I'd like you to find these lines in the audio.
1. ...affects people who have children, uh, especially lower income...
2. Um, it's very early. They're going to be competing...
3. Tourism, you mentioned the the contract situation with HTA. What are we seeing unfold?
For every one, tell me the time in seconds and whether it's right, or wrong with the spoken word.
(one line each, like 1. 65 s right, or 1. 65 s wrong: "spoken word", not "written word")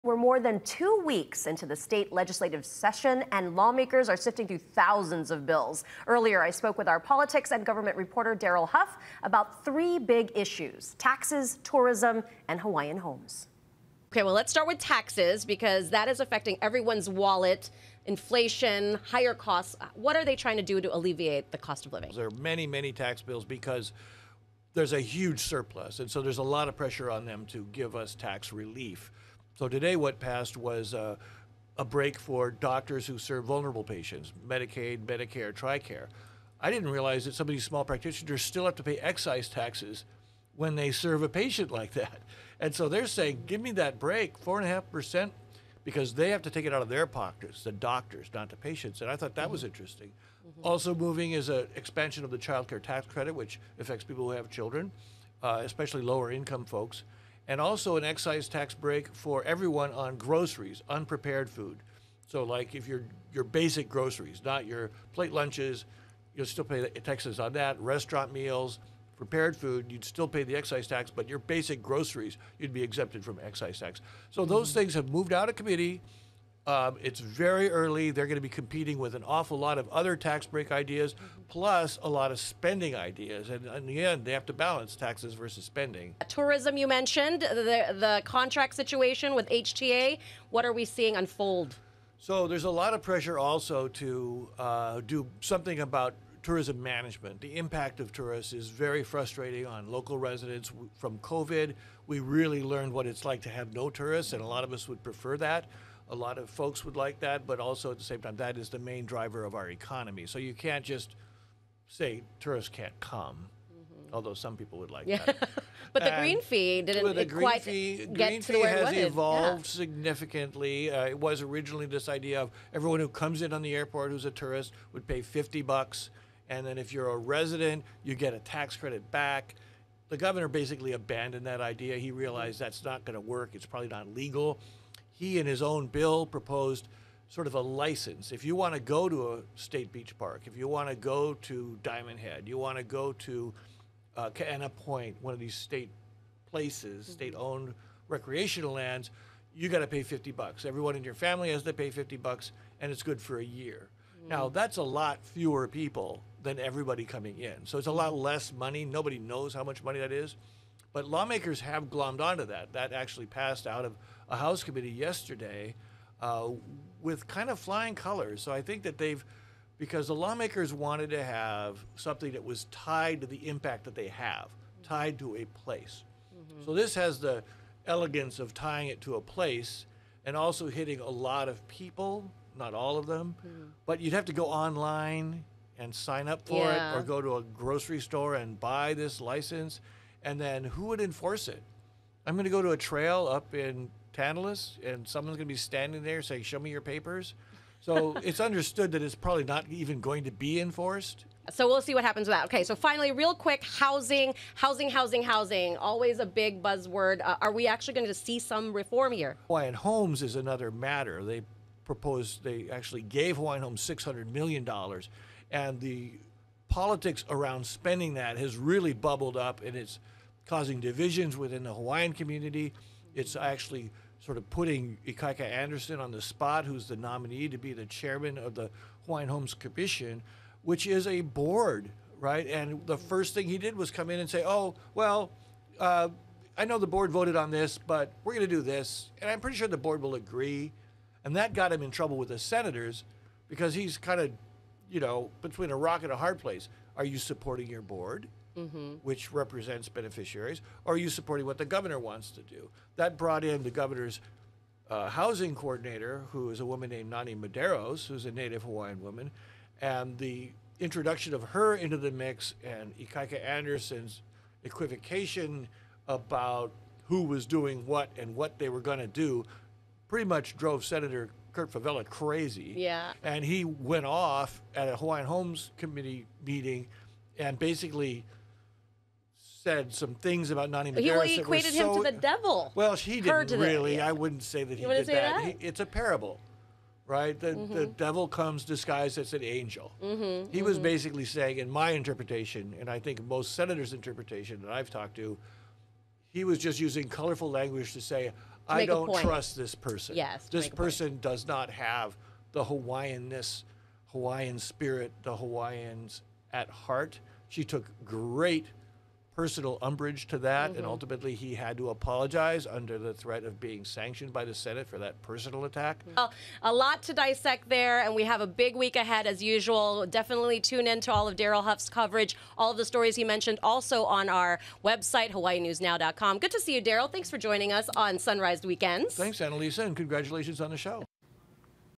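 1. 53 s right
2. 76 s right
3. 86 s right.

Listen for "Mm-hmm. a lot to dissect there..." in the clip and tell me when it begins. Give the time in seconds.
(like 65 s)
316 s.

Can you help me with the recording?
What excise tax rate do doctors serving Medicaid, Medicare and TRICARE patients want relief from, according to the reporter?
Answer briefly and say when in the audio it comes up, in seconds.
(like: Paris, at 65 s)
4.5%, at 44 s.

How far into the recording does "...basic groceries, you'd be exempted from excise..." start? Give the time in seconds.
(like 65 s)
71 s.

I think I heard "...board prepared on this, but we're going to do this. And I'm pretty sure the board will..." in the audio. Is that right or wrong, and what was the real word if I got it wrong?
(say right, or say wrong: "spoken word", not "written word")
wrong: "voted", not "prepared".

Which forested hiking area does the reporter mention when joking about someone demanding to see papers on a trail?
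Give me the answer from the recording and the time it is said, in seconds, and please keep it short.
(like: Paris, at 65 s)
Tantalus, at 194 s.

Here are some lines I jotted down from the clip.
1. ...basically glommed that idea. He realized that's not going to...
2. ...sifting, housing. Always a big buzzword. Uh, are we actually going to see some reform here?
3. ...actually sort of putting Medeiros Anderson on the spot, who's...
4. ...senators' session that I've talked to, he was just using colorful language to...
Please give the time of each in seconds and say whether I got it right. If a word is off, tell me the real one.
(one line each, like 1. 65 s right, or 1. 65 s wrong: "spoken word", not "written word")
1. 130 s wrong: "abandoned", not "glommed"
2. 204 s wrong: "housing", not "sifting"
3. 223 s wrong: "Ikaika", not "Medeiros"
4. 293 s wrong: "interpretation", not "session".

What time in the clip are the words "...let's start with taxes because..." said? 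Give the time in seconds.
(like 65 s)
14 s.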